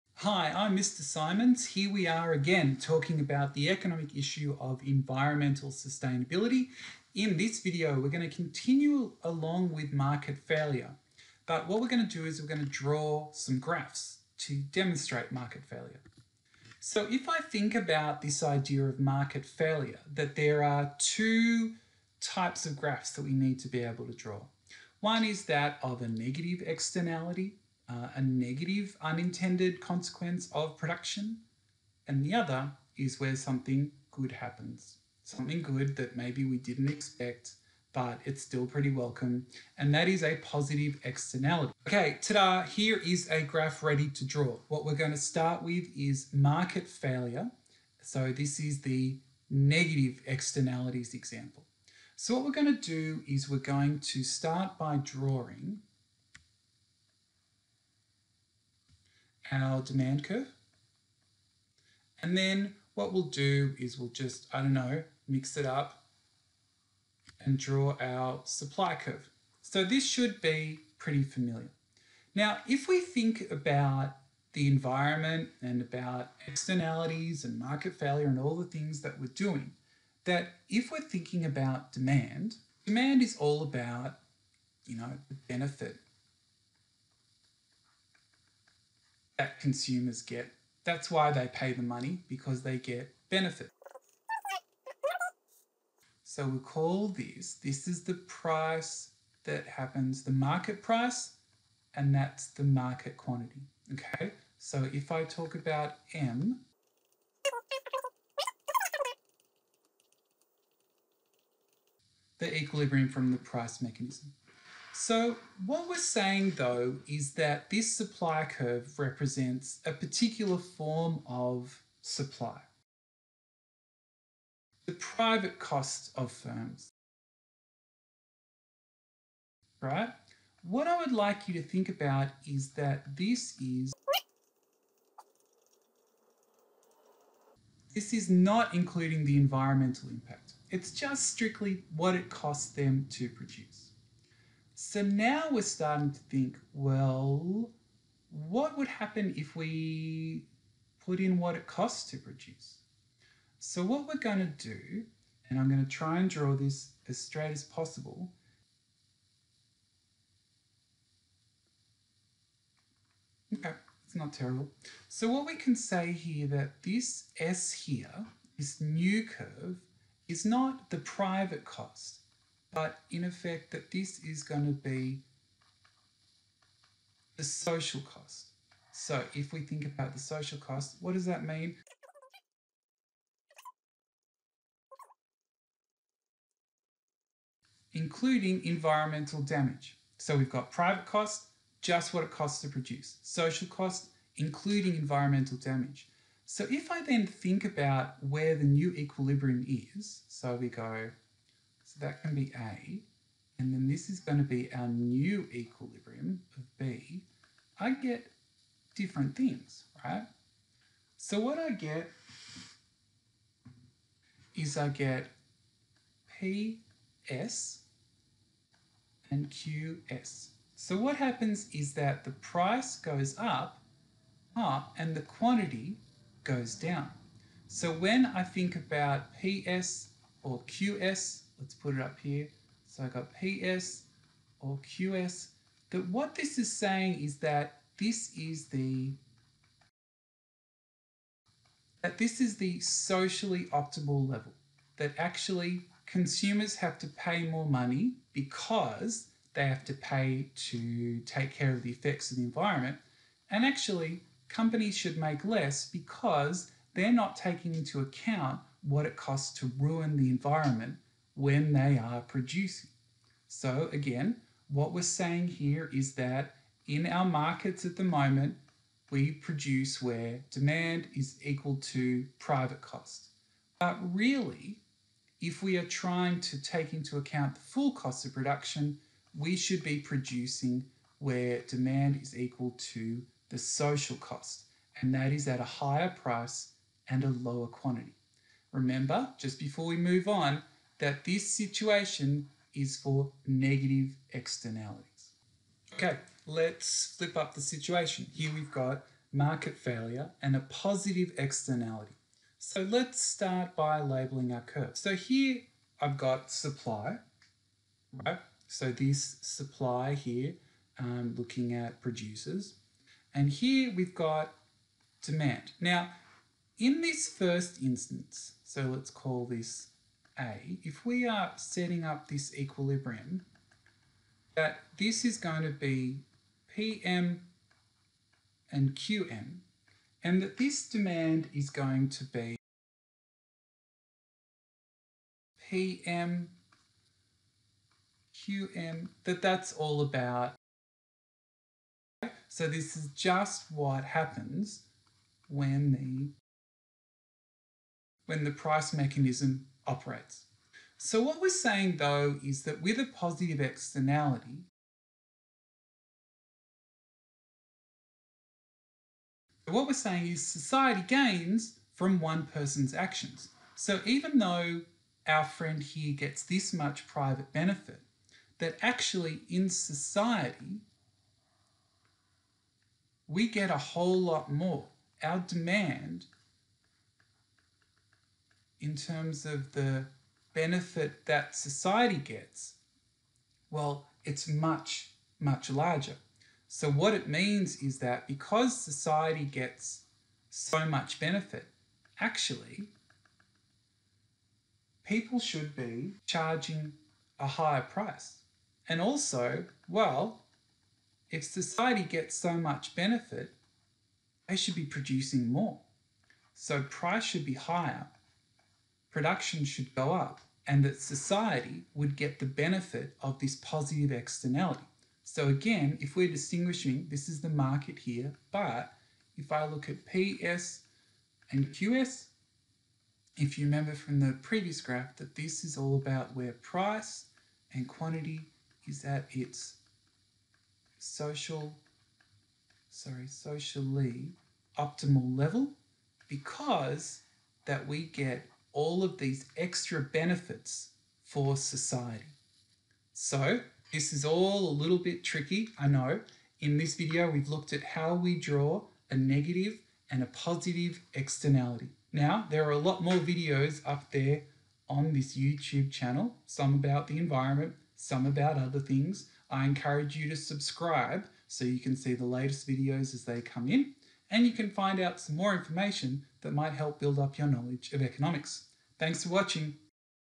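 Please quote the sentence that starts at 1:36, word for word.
So we call this, this is the price that happens, the market price, and that's the market quantity, okay?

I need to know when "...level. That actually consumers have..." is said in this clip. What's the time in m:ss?
4:04.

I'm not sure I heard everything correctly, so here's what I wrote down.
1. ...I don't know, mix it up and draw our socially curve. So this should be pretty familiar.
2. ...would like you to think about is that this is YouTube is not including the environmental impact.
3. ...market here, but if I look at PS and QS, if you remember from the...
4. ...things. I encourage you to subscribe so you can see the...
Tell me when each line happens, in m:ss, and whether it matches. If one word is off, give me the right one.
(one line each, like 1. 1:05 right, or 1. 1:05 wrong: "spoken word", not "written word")
1. 1:04 wrong: "supply", not "socially"
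2. 2:10 wrong: "This", not "YouTube"
3. 6:57 right
4. 7:38 right.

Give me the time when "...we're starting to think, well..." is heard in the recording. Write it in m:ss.
2:25.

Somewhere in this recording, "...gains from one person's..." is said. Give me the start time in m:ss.
6:01.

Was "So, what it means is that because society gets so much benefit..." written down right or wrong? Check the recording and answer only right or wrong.
right.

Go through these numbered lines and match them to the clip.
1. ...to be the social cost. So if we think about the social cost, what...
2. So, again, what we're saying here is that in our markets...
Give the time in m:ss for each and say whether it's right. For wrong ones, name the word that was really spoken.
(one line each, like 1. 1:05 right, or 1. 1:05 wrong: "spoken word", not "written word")
1. 2:54 right
2. 4:23 right.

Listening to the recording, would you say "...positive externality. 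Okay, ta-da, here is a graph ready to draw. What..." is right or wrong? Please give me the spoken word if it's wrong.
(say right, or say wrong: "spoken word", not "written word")
right.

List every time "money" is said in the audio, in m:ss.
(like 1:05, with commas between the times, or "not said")
1:31, 4:07.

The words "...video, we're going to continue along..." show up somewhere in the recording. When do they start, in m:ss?
0:07.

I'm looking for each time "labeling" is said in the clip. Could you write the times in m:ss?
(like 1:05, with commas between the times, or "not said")
5:03.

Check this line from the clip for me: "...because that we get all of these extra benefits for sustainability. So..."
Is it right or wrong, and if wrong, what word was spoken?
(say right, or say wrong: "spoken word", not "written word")
wrong: "society", not "sustainability".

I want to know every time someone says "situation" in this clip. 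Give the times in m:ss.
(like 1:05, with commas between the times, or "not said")
4:51, 4:57.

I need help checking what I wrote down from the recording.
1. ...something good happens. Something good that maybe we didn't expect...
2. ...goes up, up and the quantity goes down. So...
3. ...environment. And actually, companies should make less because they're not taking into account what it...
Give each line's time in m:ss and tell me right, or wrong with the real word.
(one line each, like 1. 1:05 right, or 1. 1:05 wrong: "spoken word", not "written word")
1. 0:33 right
2. 3:42 right
3. 4:12 right.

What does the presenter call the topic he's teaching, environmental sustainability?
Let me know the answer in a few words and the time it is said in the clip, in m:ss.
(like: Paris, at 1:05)
Economic issue, at 0:03.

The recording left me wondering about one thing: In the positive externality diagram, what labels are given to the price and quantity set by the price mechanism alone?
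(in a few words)
PM and QM.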